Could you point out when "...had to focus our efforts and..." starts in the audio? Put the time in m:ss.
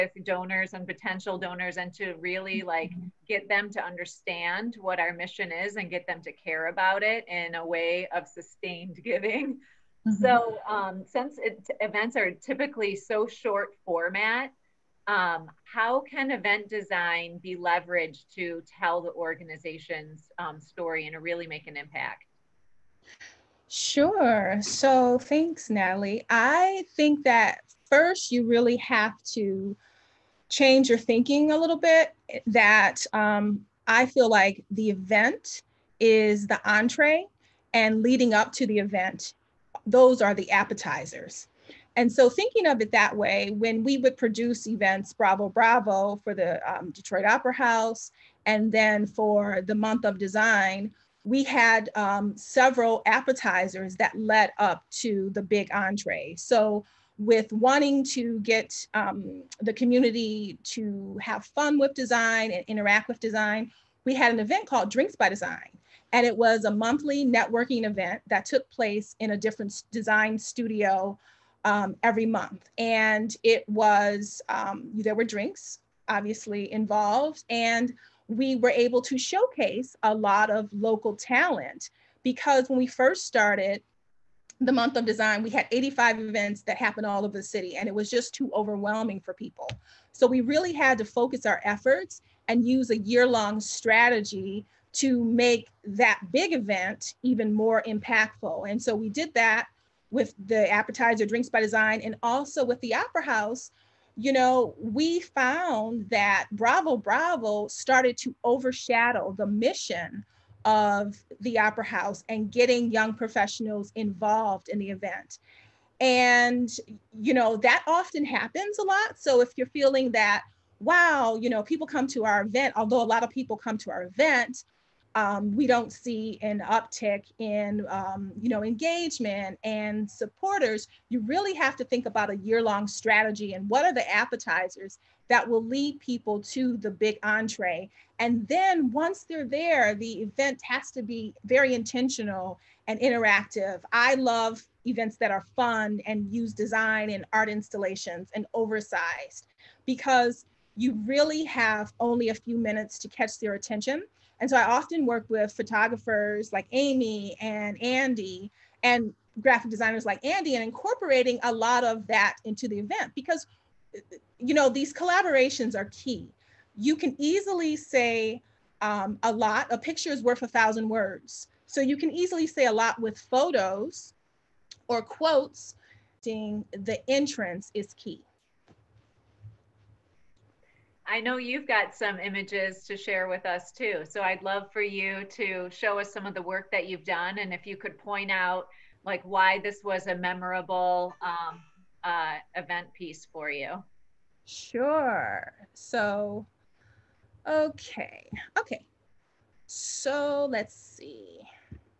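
1:30.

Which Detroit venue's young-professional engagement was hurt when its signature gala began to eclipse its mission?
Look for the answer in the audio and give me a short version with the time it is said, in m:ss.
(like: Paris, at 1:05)
Detroit Opera House, at 0:46.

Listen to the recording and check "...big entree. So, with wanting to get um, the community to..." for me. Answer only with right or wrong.
right.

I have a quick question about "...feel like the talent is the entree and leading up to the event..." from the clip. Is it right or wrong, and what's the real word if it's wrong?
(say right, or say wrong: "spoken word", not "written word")
wrong: "event", not "talent".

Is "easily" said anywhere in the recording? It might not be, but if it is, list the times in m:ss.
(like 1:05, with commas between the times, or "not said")
2:47, 2:52.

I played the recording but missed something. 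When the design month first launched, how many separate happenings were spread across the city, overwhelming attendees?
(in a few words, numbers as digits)
85.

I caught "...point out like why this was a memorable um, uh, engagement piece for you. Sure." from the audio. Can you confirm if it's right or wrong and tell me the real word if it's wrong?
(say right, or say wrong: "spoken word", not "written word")
wrong: "event", not "engagement".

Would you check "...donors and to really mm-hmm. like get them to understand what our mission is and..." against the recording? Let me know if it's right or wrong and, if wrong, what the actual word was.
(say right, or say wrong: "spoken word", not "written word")
right.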